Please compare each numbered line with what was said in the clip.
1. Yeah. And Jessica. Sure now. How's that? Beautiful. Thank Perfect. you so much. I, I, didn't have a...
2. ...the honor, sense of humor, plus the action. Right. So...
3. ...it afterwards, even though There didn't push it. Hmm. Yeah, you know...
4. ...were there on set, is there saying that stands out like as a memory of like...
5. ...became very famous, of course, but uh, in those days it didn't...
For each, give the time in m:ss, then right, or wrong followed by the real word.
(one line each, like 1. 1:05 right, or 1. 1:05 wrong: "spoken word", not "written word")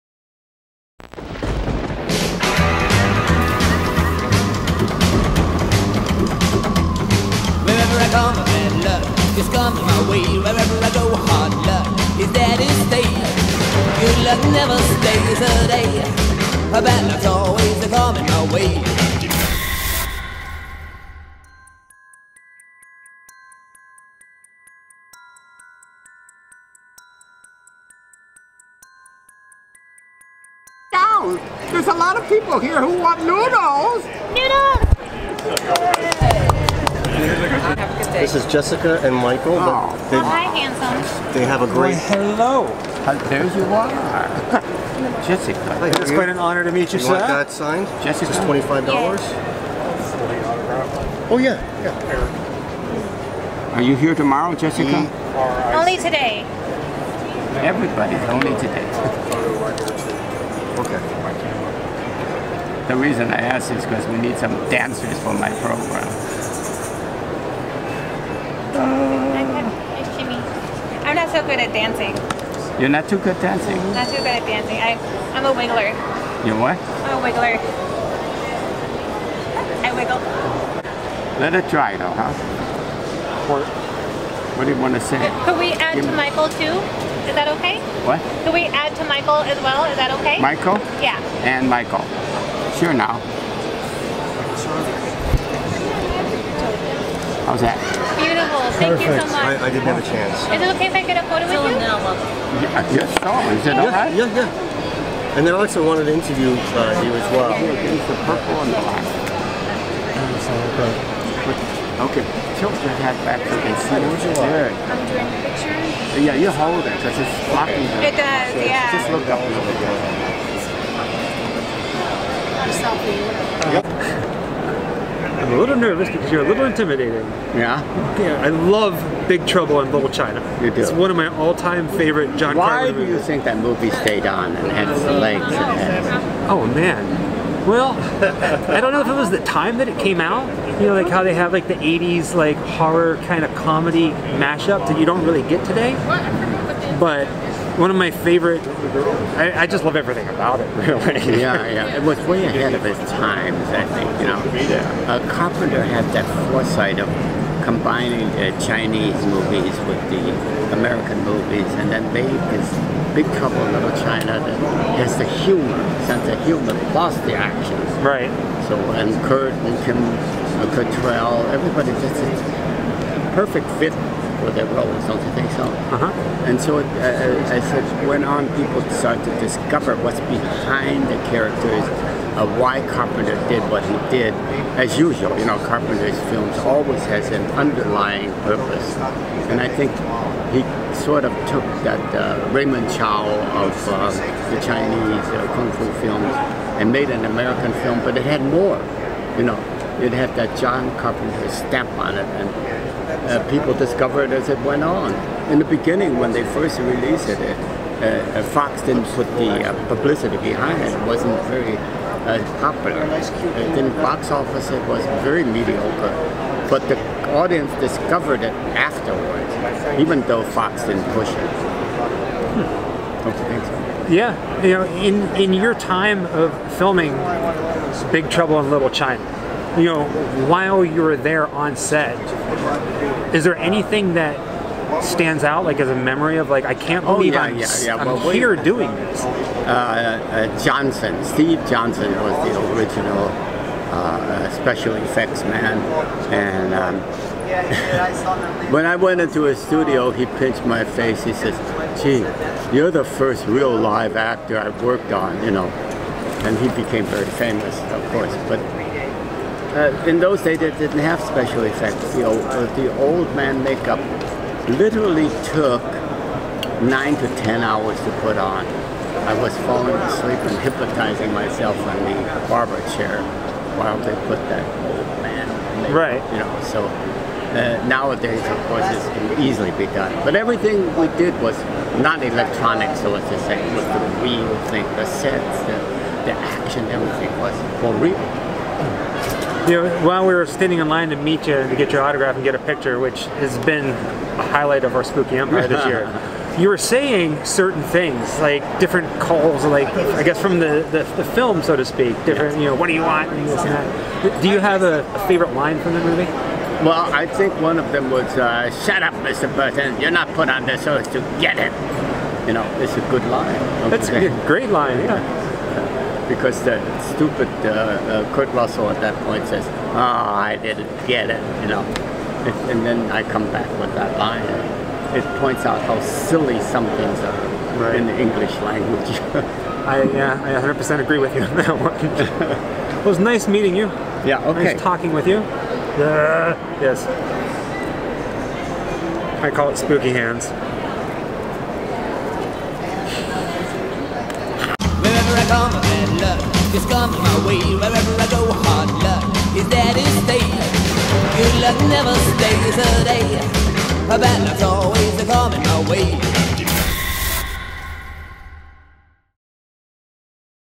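1. 1:31 wrong: "Michael", not "Jessica"
2. 2:45 wrong: "humor", not "honor"
3. 3:38 wrong: "Fox", not "There"
4. 3:51 wrong: "anything", not "saying"
5. 4:16 right.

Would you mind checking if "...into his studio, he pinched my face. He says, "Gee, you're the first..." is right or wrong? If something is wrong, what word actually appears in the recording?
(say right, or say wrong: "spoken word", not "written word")
right.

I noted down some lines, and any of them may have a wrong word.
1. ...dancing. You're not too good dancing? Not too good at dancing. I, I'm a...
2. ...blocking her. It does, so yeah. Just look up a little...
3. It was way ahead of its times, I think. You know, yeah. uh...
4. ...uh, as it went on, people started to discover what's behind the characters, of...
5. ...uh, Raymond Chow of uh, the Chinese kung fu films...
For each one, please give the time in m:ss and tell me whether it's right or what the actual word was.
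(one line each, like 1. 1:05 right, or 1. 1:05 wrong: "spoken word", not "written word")
1. 1:11 right
2. 1:57 right
3. 2:31 right
4. 2:57 right
5. 3:12 right.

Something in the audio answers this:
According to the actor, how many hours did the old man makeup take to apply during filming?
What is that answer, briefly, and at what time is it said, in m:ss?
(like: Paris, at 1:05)
9 to 10 hours, at 4:26.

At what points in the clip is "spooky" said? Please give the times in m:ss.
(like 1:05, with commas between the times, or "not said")
4:55, 5:39.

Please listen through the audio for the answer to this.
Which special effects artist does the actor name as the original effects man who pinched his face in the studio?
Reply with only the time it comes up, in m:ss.
4:01.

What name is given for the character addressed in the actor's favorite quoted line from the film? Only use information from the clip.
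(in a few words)
Mr. Burton.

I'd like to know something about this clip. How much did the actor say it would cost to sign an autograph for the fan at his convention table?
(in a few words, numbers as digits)
$25.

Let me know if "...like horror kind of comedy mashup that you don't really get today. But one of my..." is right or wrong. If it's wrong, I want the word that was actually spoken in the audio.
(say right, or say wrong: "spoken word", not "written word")
right.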